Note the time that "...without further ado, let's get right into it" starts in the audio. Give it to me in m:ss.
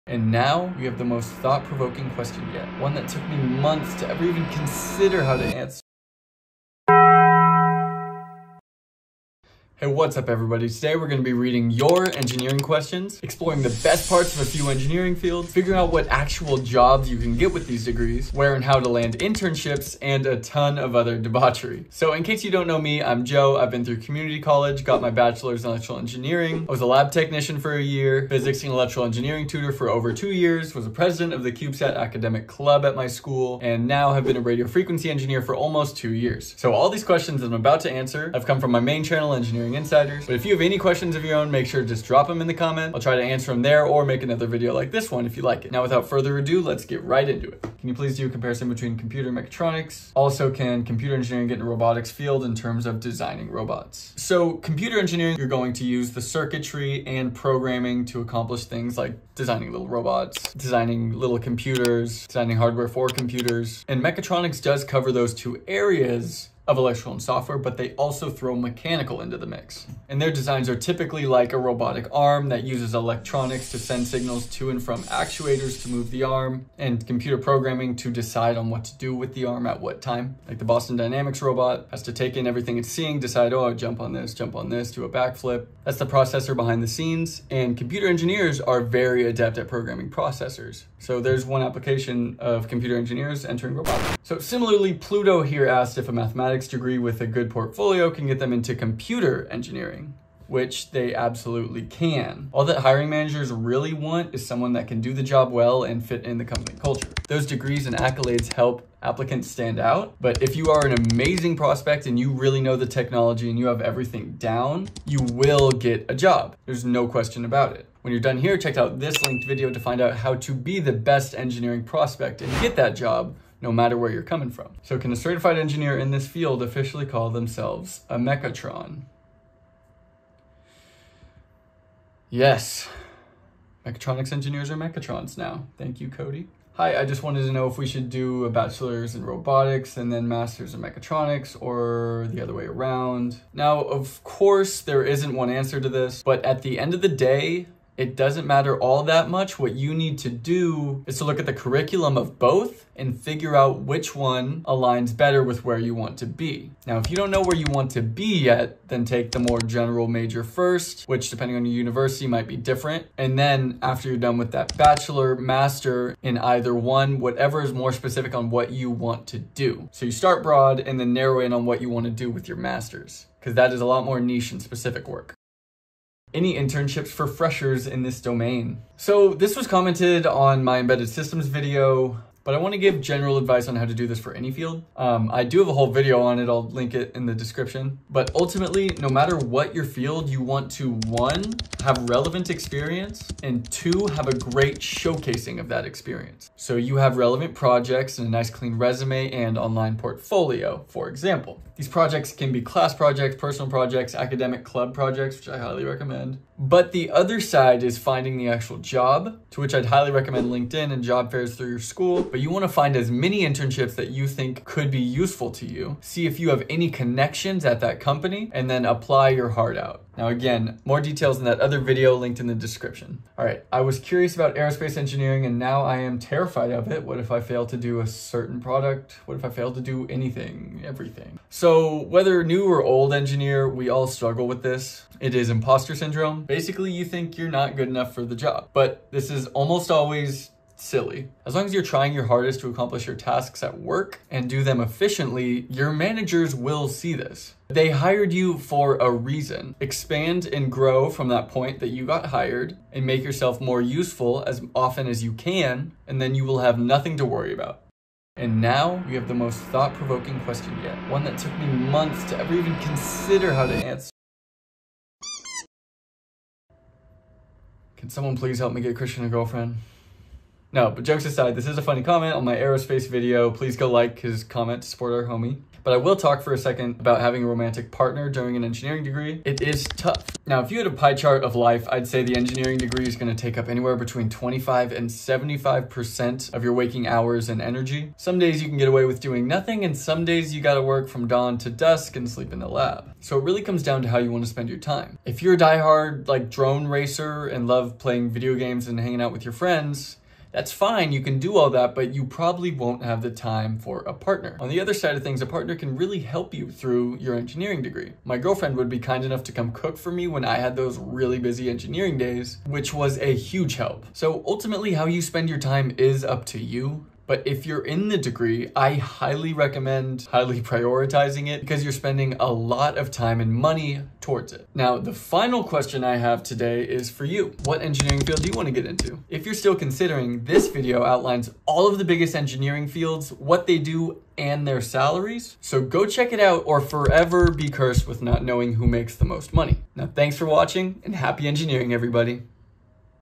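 0:45.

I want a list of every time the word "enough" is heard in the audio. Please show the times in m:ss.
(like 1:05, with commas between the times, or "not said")
3:57, 5:09.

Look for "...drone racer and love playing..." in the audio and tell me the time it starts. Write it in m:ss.
4:56.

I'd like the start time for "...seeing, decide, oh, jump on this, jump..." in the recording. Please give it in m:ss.
1:22.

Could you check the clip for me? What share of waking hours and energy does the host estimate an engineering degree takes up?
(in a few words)
25 to 75%.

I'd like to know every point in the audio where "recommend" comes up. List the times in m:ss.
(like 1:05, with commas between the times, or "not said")
3:25, 3:30, 5:19.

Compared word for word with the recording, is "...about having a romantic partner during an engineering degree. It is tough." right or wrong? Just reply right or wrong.
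right.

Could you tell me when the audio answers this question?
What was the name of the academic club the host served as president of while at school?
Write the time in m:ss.
0:31.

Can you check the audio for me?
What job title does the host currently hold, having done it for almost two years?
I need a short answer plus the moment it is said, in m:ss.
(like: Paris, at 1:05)
Radio frequency engineer, at 0:34.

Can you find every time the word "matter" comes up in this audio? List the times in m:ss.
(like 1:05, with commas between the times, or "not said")
2:03, 2:28, 3:09.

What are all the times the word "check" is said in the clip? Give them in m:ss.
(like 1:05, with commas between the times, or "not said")
1:58, 5:36.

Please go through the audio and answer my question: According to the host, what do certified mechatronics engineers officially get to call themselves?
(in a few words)
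Mechatrons.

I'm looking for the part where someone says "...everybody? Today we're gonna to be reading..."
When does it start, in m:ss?
0:10.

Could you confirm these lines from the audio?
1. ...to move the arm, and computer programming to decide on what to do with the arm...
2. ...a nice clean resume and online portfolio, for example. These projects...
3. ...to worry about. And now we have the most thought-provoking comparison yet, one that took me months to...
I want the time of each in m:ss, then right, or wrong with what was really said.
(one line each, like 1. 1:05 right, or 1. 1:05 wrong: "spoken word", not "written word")
1. 1:15 right
2. 3:18 right
3. 4:17 wrong: "question", not "comparison".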